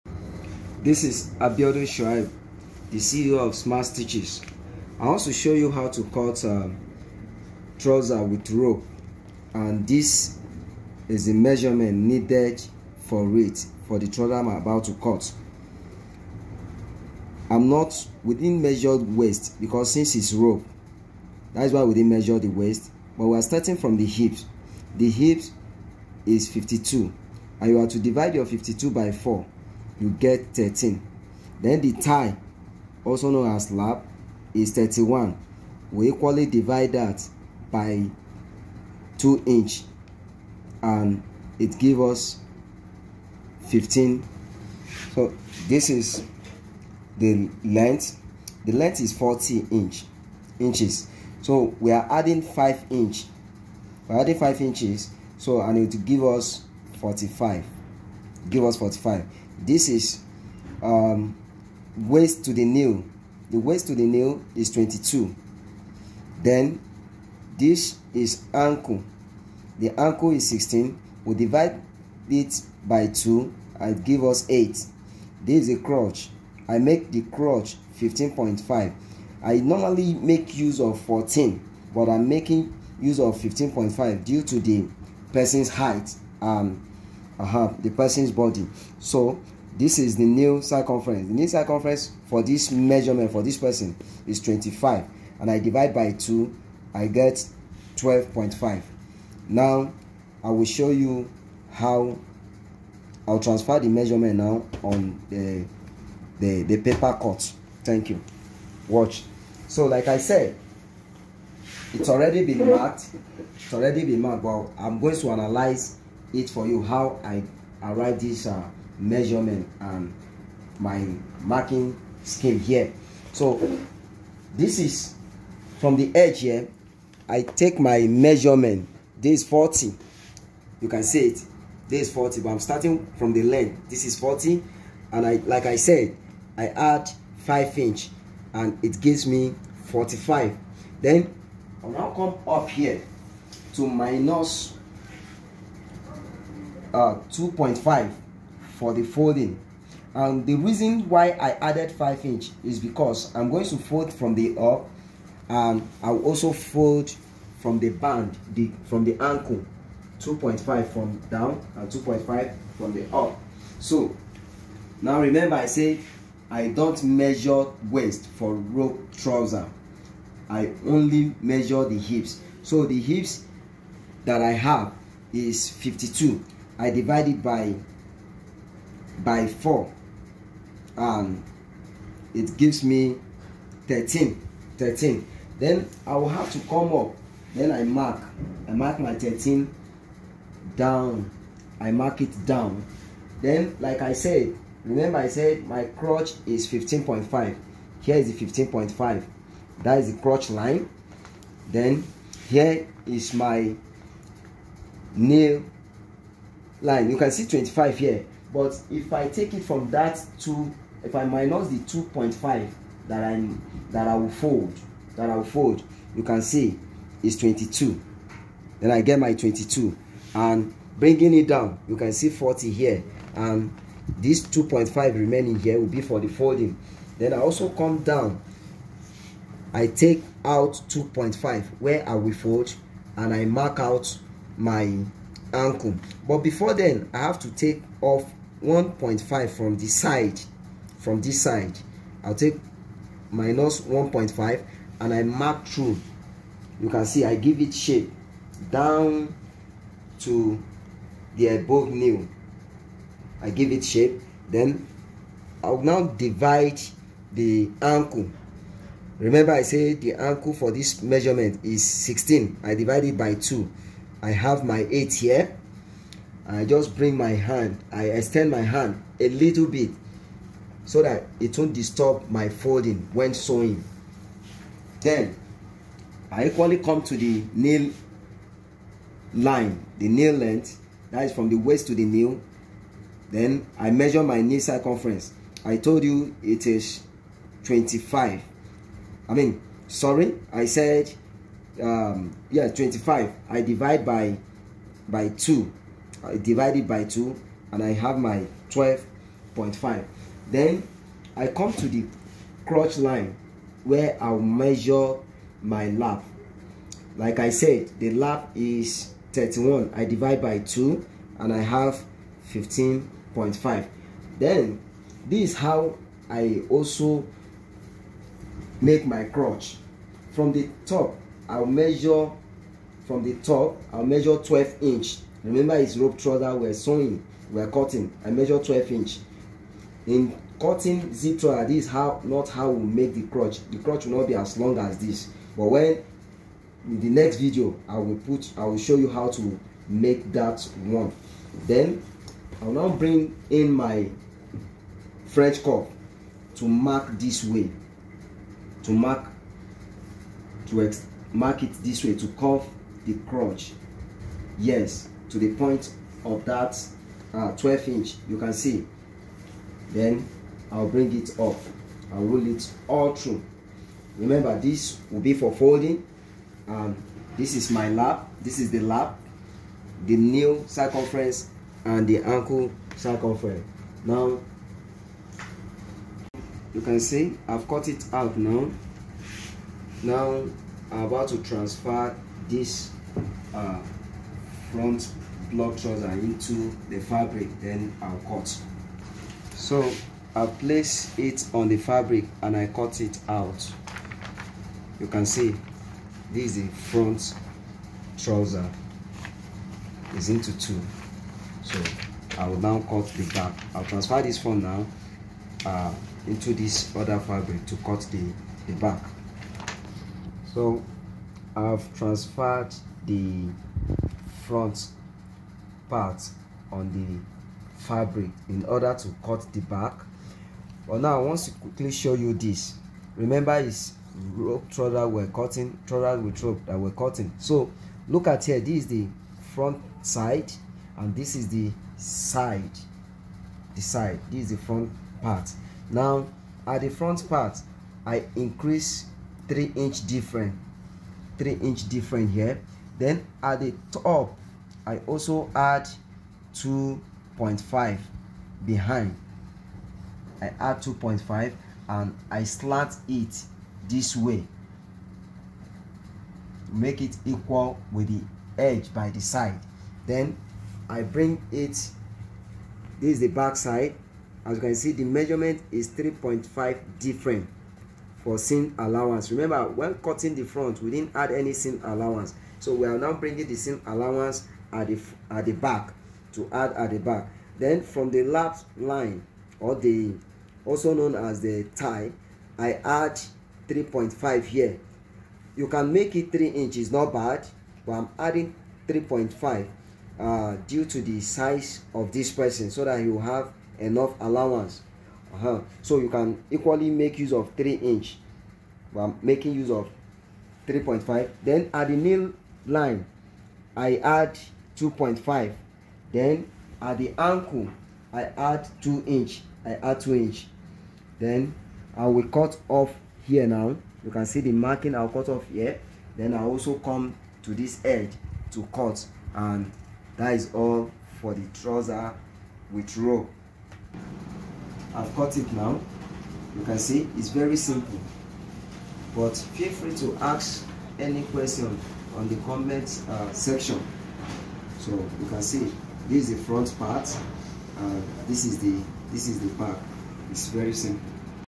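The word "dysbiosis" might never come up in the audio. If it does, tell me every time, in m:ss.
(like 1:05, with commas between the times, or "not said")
not said.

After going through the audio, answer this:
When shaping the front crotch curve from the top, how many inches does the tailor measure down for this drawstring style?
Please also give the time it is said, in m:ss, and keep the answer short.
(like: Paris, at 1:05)
12 inches, at 5:23.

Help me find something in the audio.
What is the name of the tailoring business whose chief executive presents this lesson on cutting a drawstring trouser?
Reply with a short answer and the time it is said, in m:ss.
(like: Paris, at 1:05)
Smart Stitches, at 0:03.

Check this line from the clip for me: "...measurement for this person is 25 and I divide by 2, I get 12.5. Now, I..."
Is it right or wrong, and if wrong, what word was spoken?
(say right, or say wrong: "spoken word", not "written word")
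right.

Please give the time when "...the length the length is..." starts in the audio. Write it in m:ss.
0:47.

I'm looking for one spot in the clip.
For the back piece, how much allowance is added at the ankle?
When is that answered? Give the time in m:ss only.
8:26.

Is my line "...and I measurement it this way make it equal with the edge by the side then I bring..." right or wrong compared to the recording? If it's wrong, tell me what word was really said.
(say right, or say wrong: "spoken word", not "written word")
wrong: "slant", not "measurement".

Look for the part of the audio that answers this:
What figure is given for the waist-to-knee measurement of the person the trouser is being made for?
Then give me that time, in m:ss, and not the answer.
1:03.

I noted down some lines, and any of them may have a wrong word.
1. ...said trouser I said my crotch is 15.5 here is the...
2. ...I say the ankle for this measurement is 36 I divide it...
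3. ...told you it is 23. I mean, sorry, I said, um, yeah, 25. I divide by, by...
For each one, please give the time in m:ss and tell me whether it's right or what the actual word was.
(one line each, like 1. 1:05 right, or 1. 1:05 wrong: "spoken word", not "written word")
1. 3:14 wrong: "remember", not "trouser"
2. 4:19 wrong: "16", not "36"
3. 4:45 wrong: "25", not "23".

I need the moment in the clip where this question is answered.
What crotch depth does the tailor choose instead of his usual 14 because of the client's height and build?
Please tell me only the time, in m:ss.
1:16.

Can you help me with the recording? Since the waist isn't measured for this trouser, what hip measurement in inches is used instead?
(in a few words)
52.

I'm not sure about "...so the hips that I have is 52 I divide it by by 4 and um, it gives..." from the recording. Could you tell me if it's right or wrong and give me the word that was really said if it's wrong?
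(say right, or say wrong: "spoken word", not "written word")
right.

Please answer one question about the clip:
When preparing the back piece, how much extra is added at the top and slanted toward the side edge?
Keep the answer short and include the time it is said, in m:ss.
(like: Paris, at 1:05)
2.5 inches, at 7:23.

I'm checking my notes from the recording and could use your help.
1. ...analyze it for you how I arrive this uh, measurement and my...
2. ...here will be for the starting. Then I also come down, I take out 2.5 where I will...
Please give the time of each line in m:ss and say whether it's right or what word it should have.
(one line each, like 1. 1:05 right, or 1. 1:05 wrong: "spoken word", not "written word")
1. 1:55 right
2. 3:45 wrong: "folding", not "starting".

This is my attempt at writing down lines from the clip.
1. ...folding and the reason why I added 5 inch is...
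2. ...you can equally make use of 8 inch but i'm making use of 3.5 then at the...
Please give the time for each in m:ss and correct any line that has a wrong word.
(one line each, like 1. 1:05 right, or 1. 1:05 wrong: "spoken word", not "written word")
1. 2:29 right
2. 8:15 wrong: "3", not "8".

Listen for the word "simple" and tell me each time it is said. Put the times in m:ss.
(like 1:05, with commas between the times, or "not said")
8:47, 9:00.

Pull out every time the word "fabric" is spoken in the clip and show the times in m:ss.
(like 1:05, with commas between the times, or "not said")
6:26, 6:31, 6:47, 6:57.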